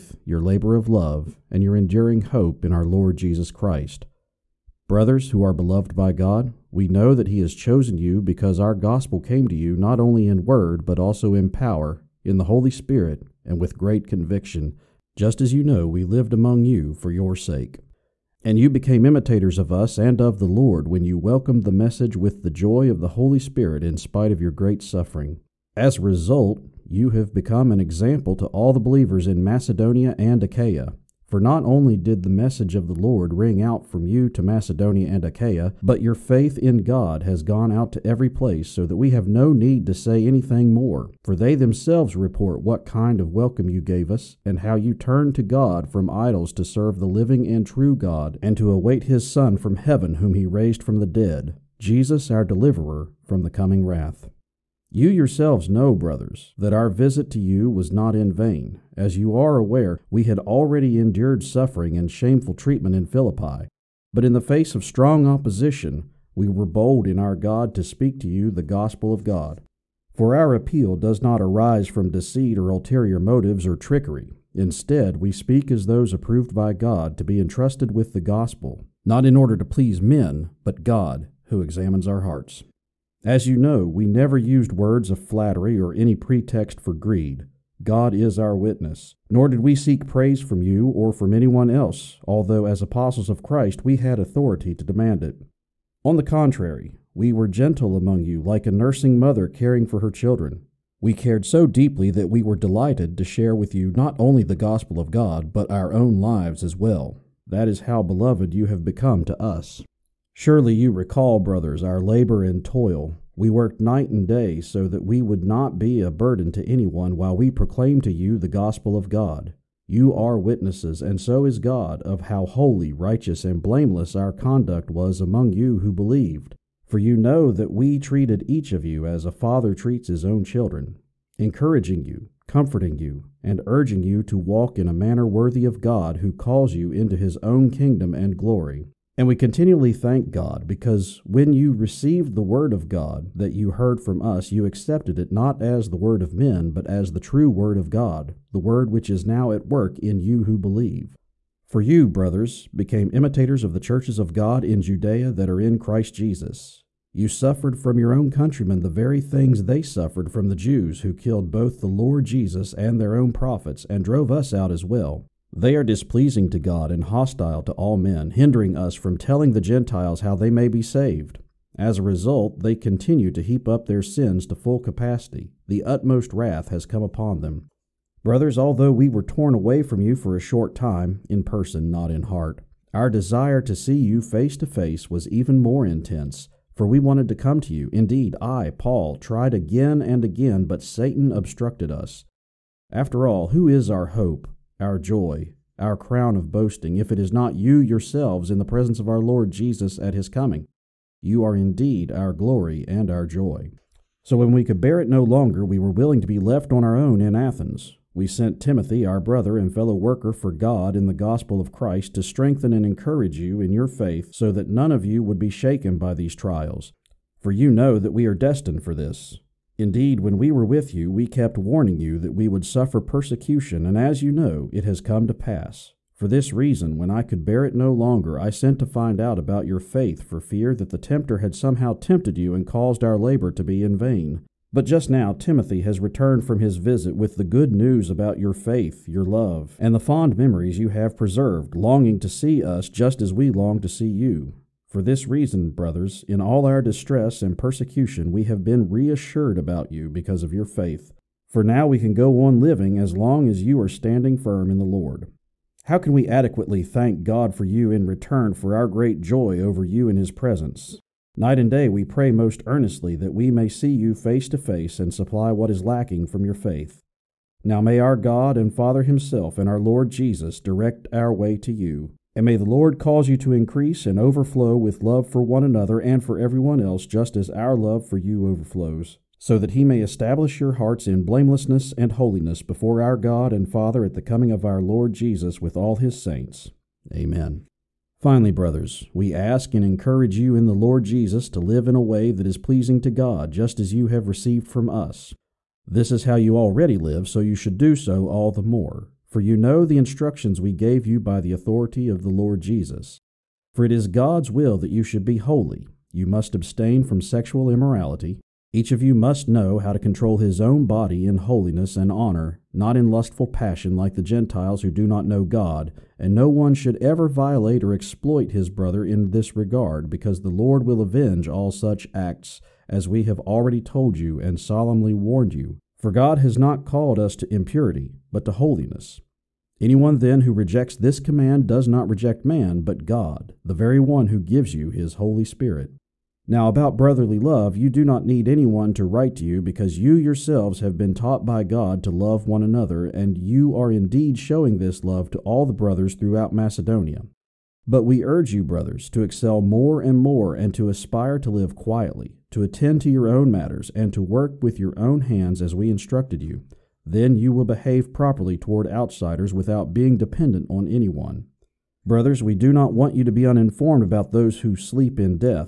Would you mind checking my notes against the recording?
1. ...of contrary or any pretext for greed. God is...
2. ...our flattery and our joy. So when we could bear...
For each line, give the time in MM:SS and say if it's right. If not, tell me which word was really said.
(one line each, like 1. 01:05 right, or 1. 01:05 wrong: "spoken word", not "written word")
1. 01:25 wrong: "flattery", not "contrary"
2. 03:22 wrong: "glory", not "flattery".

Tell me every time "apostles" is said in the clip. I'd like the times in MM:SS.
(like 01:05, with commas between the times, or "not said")
01:32.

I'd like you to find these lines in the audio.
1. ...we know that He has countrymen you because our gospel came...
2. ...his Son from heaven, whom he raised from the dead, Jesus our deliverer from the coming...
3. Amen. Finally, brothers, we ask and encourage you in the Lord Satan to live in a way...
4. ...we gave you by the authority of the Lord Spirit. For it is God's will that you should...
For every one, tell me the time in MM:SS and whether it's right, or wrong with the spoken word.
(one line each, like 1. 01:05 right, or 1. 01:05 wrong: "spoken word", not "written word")
1. 00:06 wrong: "chosen", not "countrymen"
2. 00:49 right
3. 04:47 wrong: "Jesus", not "Satan"
4. 05:00 wrong: "Jesus", not "Spirit".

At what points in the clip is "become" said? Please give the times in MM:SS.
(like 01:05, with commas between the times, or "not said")
00:27, 01:48.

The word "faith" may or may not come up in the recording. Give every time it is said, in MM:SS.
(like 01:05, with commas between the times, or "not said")
00:36, 03:33, 03:49, 03:58, 04:10, 04:26.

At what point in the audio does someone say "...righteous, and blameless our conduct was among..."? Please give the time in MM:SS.
02:02.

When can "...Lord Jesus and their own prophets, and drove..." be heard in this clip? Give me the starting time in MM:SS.
02:41.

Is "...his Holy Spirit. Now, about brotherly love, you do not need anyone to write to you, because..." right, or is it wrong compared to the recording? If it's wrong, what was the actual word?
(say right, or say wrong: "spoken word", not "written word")
right.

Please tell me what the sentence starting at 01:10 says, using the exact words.
For our appeal does not arise from deceit or ulterior motives or trickery.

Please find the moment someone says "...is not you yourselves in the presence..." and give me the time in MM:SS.
03:17.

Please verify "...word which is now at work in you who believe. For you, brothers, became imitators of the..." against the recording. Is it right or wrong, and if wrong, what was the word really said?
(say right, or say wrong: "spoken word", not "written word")
right.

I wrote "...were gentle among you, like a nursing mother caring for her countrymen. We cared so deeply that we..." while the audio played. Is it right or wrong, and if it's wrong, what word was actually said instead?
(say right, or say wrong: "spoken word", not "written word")
wrong: "children", not "countrymen".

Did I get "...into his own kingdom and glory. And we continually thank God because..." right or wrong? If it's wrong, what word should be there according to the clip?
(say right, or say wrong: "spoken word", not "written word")
right.